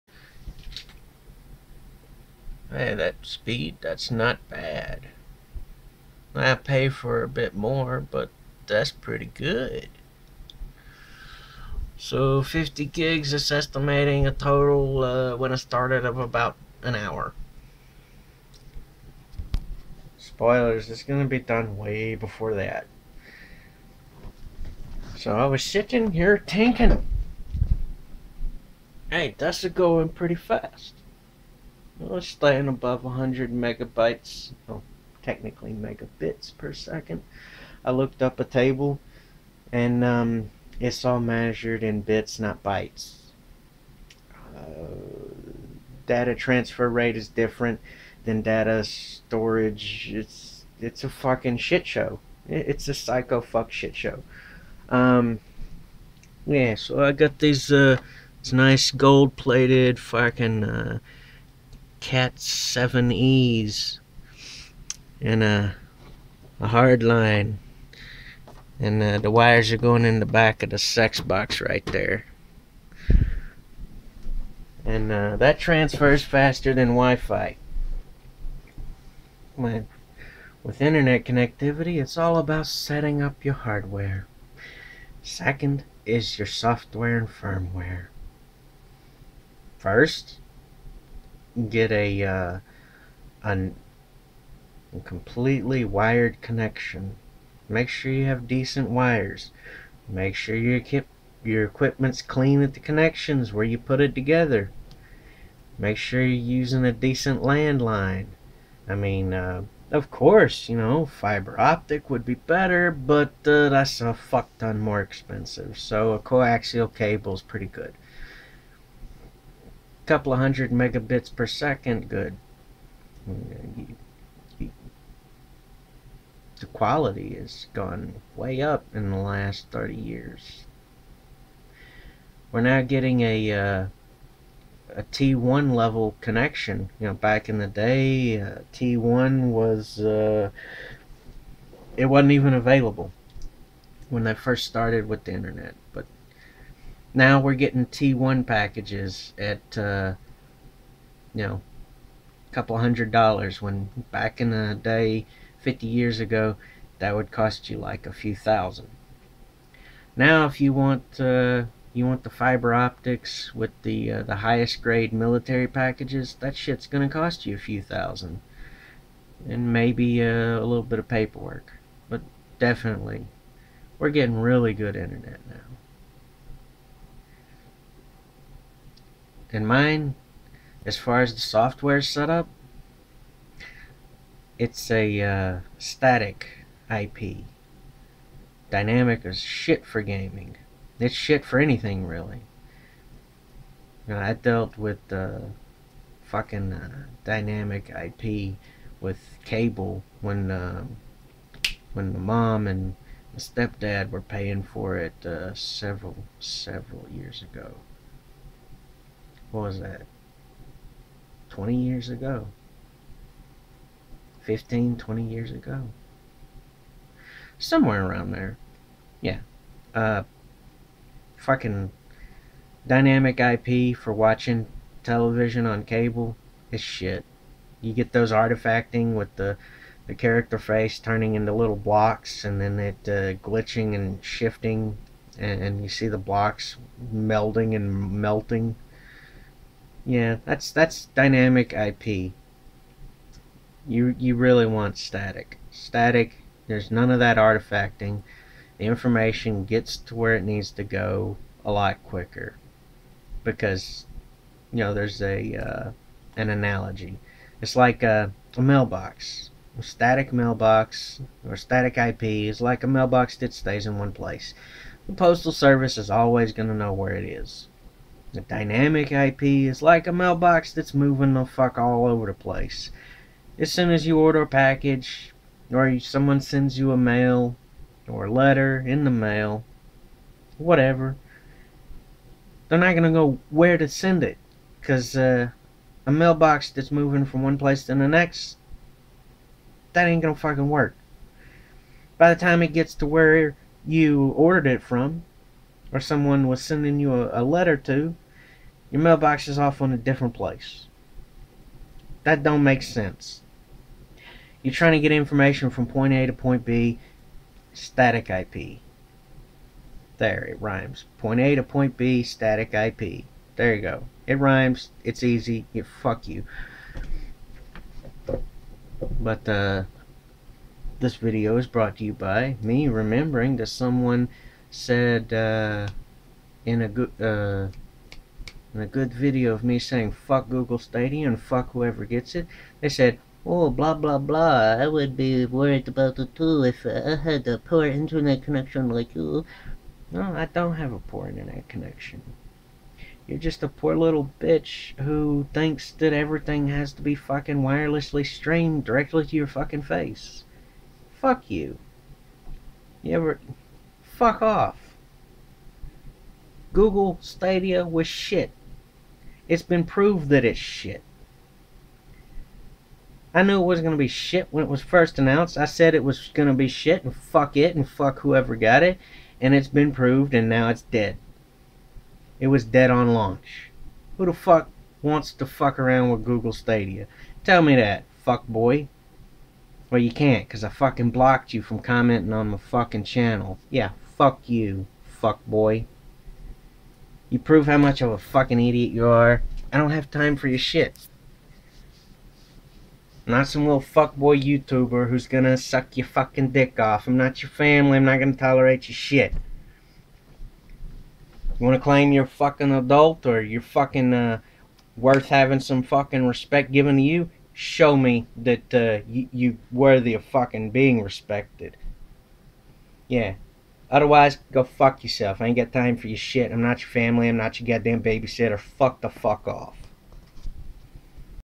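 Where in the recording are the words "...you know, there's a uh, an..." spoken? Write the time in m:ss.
4:14.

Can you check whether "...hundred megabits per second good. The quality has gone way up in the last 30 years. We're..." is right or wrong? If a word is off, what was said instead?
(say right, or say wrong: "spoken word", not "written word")
right.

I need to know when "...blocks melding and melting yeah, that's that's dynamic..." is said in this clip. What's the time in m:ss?
3:56.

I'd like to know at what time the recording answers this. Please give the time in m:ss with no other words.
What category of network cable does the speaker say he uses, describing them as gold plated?
1:02.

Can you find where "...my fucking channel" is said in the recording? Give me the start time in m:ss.
6:22.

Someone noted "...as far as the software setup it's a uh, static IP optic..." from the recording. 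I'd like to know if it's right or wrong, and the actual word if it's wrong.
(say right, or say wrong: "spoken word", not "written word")
wrong: "dynamic", not "optic".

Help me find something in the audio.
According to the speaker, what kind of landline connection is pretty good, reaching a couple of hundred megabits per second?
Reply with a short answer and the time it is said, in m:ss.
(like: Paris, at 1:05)
coaxial cable, at 1:56.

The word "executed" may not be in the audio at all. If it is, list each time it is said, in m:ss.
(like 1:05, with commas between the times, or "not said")
not said.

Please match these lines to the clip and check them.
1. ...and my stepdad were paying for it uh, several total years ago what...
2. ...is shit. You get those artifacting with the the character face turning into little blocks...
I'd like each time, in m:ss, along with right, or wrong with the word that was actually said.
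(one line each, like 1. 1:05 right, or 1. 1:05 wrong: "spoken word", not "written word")
1. 3:22 wrong: "several", not "total"
2. 3:46 right.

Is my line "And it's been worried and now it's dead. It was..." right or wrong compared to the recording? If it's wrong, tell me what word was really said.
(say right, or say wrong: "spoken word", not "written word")
wrong: "proved", not "worried".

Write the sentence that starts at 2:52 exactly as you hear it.
But definitely, we're getting really good internet now.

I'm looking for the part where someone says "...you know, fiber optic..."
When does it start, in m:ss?
1:50.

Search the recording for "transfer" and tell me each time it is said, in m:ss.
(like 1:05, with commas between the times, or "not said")
0:46, 1:15.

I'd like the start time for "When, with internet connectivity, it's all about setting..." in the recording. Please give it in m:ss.
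1:19.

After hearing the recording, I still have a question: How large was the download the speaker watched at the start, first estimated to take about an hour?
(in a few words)
50 gigs.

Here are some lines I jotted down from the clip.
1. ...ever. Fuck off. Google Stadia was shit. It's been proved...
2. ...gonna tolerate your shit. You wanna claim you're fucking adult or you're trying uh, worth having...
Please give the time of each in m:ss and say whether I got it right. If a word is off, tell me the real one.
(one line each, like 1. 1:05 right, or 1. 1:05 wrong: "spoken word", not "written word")
1. 5:53 right
2. 6:38 wrong: "fucking", not "trying".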